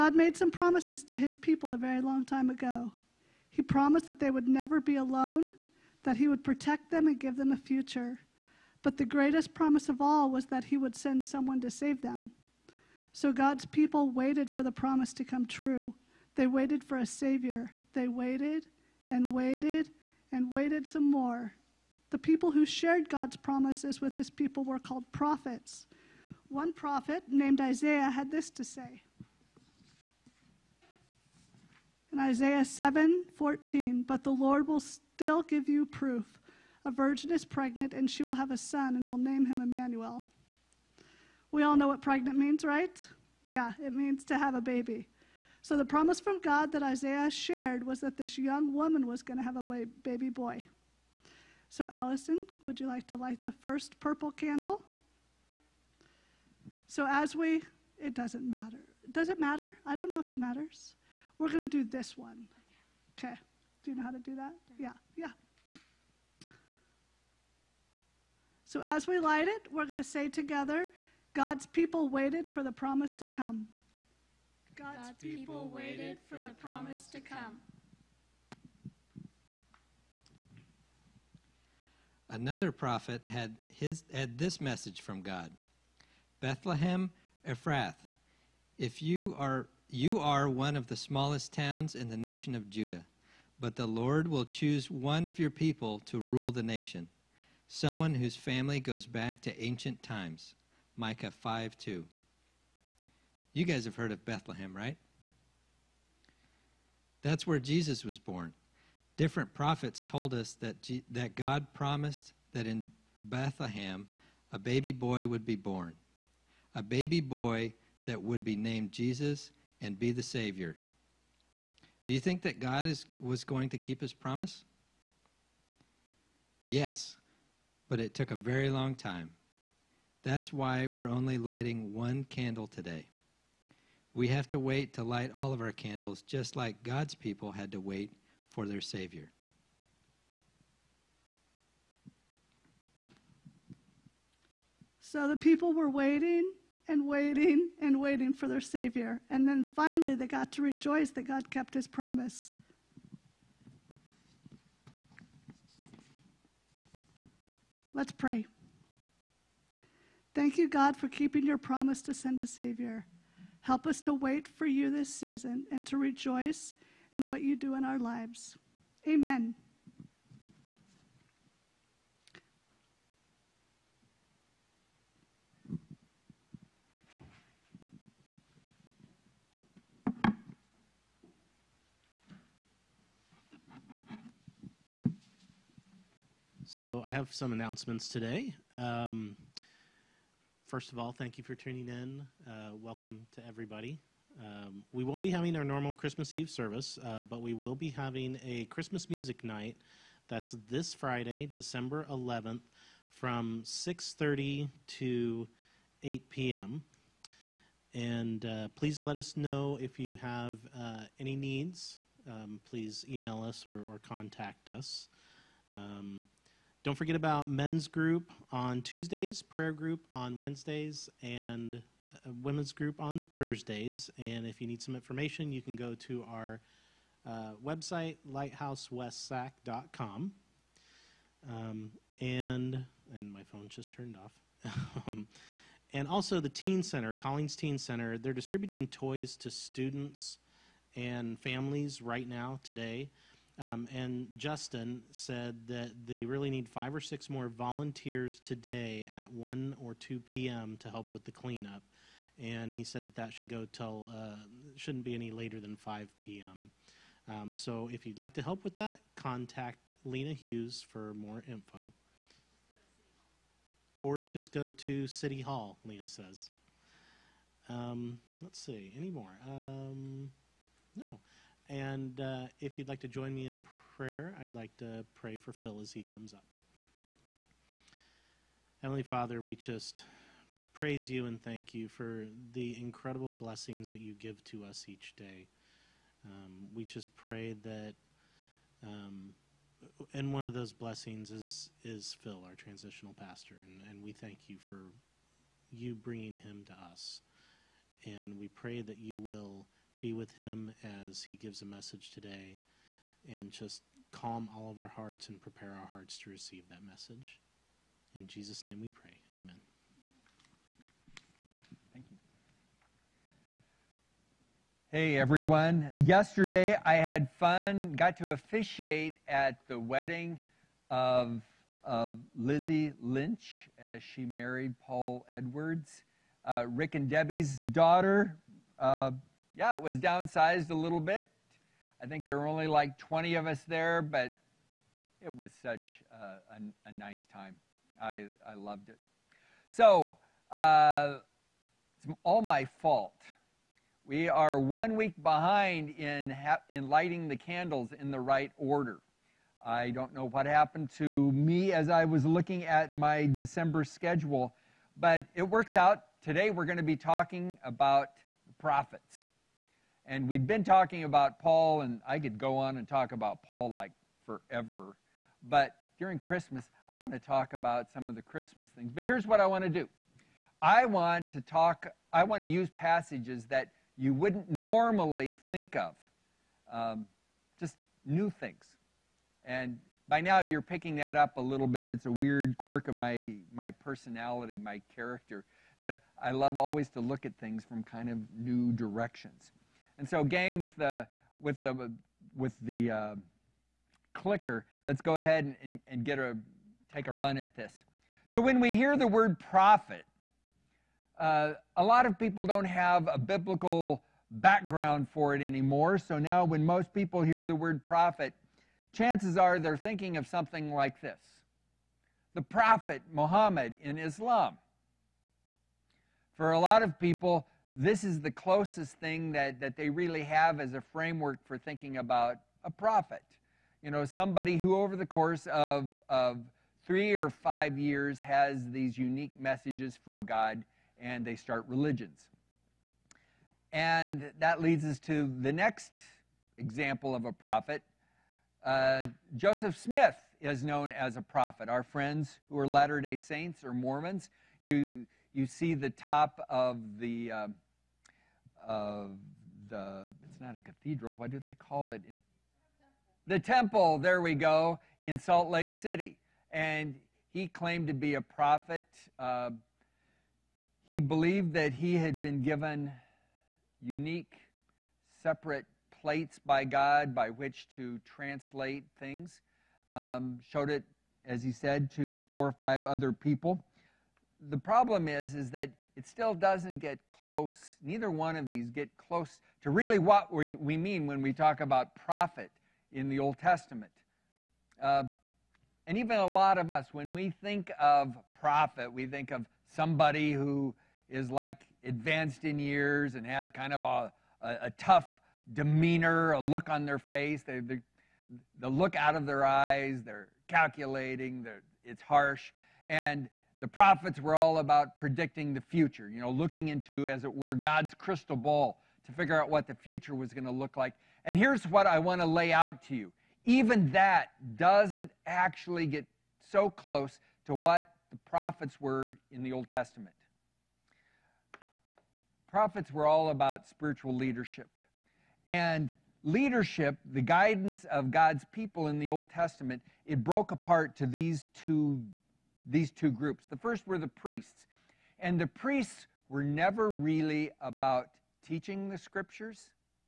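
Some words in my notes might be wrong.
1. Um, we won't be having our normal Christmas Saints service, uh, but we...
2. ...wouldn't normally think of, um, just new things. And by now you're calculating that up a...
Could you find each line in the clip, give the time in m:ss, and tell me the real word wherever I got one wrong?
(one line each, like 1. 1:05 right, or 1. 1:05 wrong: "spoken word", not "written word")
1. 3:14 wrong: "Eve", not "Saints"
2. 6:14 wrong: "picking", not "calculating".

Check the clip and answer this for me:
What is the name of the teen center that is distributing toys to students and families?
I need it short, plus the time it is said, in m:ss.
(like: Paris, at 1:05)
Collins Teen Center, at 3:57.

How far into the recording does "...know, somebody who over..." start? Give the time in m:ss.
7:03.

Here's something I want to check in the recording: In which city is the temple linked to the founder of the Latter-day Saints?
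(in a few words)
Salt Lake City.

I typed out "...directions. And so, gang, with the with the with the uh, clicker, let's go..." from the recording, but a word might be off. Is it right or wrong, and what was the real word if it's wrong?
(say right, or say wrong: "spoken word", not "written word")
right.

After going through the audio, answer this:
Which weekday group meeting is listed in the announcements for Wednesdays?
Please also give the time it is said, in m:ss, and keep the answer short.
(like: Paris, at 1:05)
Prayer group, at 3:39.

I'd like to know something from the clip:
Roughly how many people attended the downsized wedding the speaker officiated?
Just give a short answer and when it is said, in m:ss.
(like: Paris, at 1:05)
20, at 5:32.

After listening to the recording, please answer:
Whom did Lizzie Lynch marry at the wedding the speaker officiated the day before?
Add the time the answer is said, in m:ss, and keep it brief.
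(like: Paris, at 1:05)
Paul Edwards, at 5:24.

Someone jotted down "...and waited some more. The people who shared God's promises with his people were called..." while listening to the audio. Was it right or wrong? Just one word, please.
right.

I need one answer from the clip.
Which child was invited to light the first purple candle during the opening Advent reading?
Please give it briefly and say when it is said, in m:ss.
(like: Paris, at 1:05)
Allison, at 0:51.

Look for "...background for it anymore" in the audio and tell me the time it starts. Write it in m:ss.
6:44.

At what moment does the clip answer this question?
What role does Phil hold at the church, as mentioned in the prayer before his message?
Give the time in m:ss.
4:52.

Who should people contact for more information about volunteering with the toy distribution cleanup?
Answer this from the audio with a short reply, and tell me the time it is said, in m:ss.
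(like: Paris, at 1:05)
Lena Hughes, at 4:20.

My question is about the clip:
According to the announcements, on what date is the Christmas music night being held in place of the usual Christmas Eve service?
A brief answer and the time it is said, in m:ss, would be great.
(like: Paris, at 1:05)
December 11th, at 3:21.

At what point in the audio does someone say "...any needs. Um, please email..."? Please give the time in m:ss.
3:31.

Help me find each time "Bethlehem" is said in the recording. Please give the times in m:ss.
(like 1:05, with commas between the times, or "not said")
1:26, 1:44, 1:53.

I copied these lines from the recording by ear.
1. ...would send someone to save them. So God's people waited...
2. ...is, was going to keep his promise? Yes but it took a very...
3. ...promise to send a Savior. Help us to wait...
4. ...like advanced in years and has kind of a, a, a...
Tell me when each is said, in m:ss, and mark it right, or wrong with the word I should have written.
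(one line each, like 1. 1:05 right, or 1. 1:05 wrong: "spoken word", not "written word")
1. 0:10 right
2. 2:02 right
3. 2:41 right
4. 8:11 right.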